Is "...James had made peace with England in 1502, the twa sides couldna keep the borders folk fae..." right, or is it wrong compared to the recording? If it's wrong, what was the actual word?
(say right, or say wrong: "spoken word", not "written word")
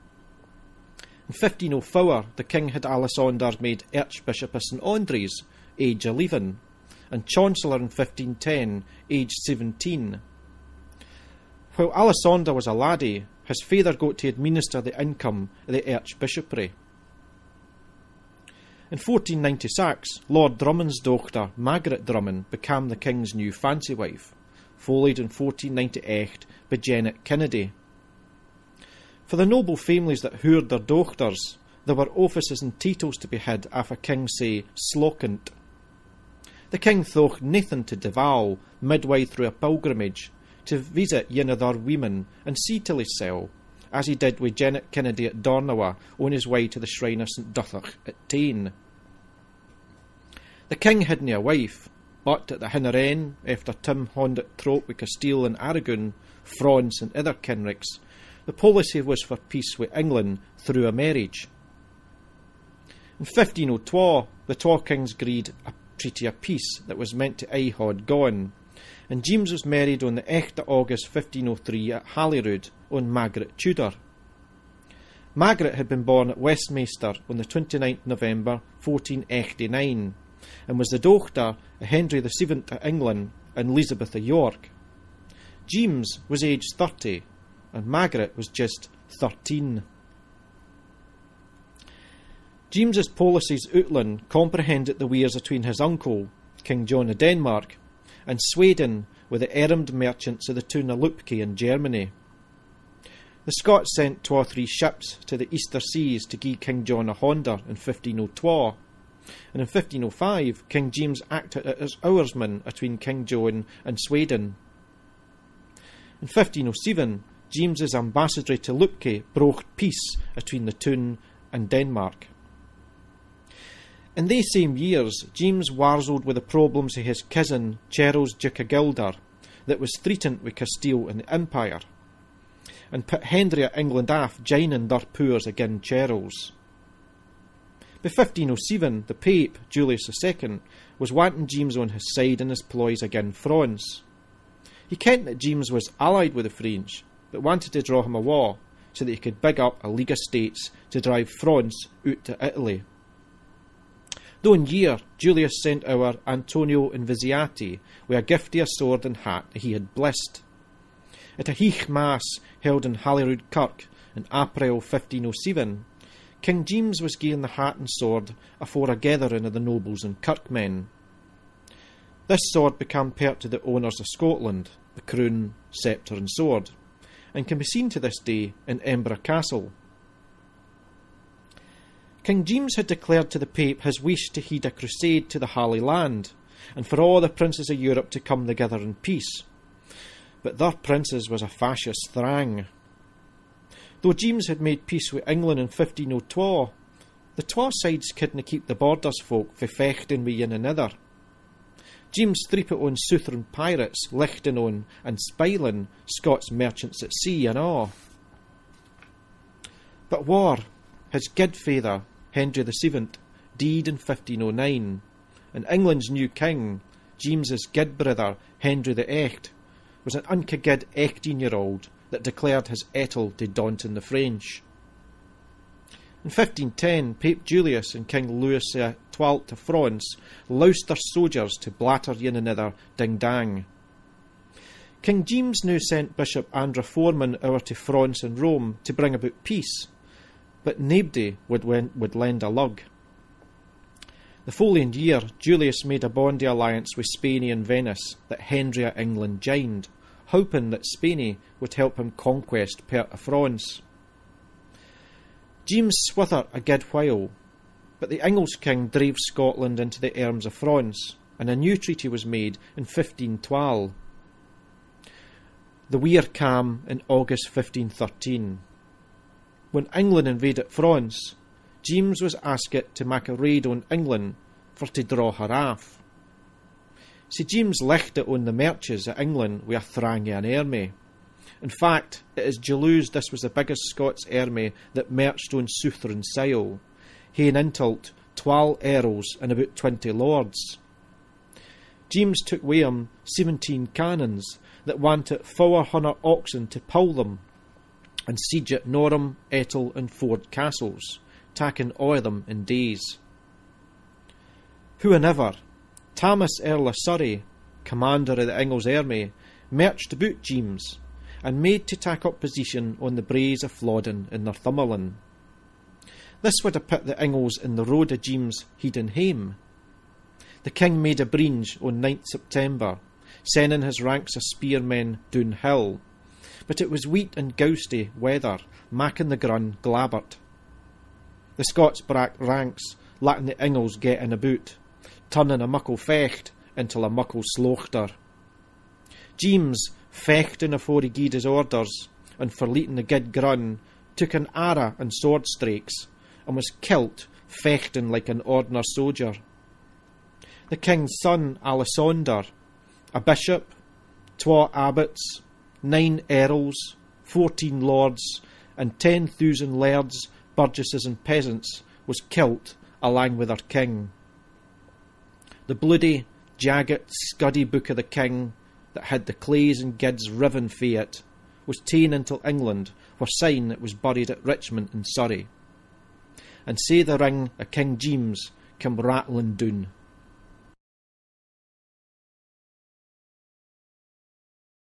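right.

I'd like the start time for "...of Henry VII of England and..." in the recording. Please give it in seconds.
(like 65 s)
81 s.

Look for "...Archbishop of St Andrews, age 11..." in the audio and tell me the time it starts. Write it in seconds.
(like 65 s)
3 s.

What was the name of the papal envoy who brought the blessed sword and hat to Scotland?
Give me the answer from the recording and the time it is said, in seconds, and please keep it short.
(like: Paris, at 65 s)
Antonio Invisiati, at 156 s.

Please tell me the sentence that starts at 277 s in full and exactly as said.
See James left it on the marches at England with a an army.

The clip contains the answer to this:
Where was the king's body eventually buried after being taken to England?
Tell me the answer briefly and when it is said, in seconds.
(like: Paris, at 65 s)
Richmond in Surrey, at 374 s.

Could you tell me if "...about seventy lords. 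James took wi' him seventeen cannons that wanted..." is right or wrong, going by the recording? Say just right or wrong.
wrong.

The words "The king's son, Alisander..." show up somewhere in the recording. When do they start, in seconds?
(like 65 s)
350 s.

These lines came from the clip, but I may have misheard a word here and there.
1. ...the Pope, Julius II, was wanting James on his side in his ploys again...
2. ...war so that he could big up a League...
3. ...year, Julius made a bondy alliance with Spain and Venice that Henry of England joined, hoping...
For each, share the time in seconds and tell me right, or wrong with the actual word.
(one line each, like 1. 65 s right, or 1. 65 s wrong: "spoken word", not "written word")
1. 139 s right
2. 148 s right
3. 244 s right.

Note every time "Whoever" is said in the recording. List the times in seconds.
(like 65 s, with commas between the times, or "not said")
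305 s.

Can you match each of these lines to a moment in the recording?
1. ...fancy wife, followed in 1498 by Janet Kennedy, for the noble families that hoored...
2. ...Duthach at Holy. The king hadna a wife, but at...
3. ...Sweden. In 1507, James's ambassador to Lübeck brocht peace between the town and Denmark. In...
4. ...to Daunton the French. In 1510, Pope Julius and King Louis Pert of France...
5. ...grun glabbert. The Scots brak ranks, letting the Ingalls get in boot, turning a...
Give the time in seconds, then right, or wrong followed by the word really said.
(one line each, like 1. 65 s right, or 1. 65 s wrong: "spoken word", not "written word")
1. 23 s right
2. 47 s wrong: "Tain", not "Holy"
3. 113 s right
4. 223 s wrong: "XII", not "Pert"
5. 329 s right.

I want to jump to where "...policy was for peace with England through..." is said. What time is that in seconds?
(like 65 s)
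58 s.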